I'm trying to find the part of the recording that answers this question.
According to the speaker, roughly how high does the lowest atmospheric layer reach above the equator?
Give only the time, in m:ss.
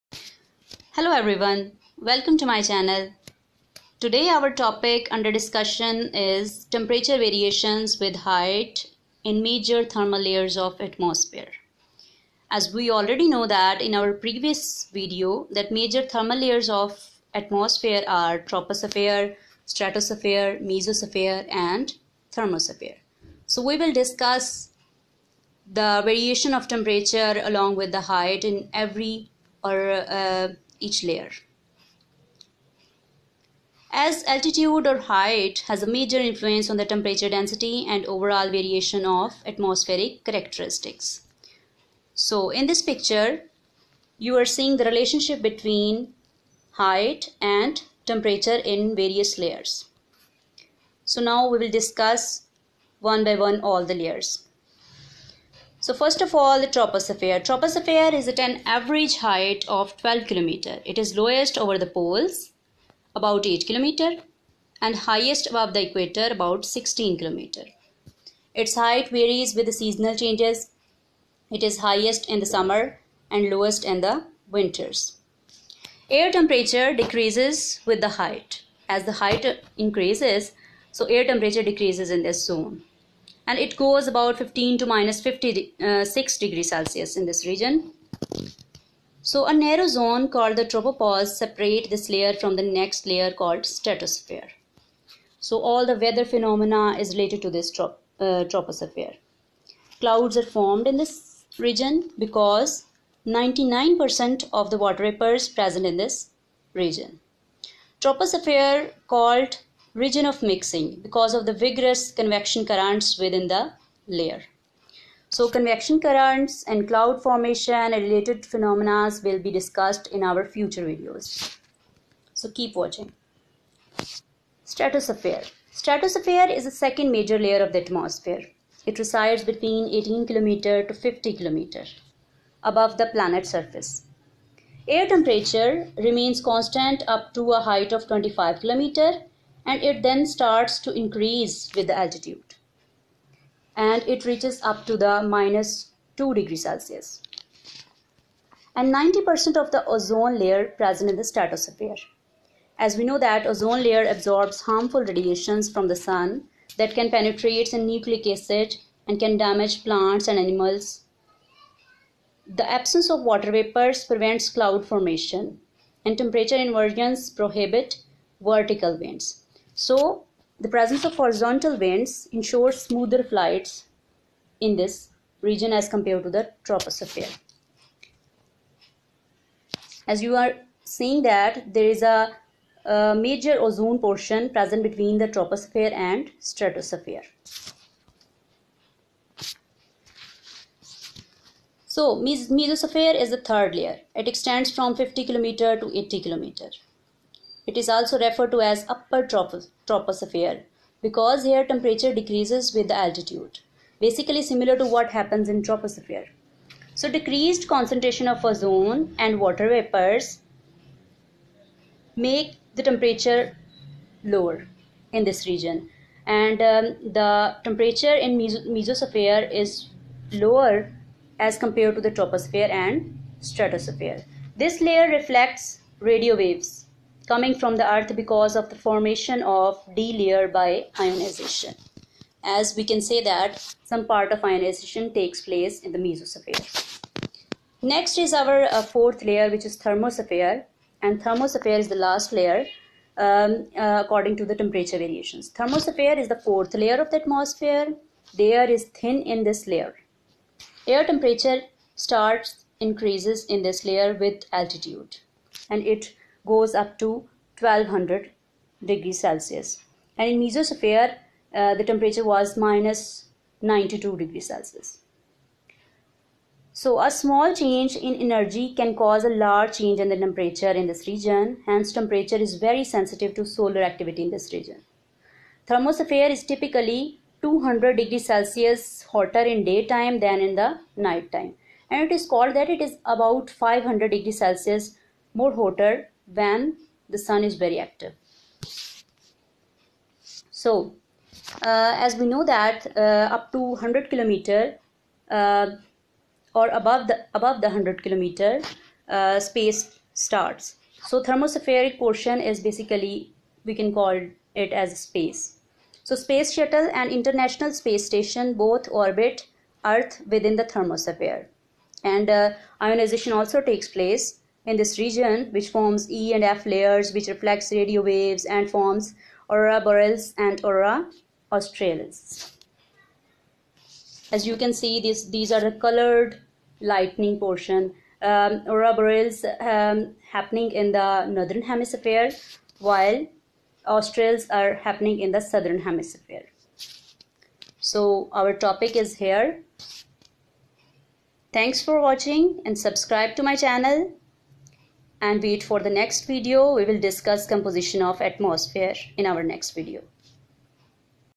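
1:06.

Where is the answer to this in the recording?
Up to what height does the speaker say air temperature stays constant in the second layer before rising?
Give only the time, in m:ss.
2:18.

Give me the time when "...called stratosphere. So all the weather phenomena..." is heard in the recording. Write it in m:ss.
1:33.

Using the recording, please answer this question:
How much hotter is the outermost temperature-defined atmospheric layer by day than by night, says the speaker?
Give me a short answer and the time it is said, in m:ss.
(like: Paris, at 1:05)
200 degrees Celsius, at 4:37.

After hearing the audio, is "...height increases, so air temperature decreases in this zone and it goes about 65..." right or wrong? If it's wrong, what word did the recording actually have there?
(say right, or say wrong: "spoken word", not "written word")
wrong: "15", not "65".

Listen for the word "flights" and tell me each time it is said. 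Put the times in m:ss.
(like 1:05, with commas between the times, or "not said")
2:53.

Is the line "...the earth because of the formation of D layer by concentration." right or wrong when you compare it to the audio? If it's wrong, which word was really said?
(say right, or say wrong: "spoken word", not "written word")
wrong: "ionization", not "concentration".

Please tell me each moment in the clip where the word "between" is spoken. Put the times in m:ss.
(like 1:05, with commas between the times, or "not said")
0:45, 2:09, 3:04.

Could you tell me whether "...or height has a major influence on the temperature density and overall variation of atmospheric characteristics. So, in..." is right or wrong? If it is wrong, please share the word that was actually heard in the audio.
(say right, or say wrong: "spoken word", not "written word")
right.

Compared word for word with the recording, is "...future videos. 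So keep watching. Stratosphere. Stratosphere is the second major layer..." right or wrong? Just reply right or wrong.
right.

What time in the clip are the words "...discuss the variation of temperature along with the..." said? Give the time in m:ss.
0:23.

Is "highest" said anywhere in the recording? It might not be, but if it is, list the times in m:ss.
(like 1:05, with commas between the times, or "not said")
1:05, 1:11.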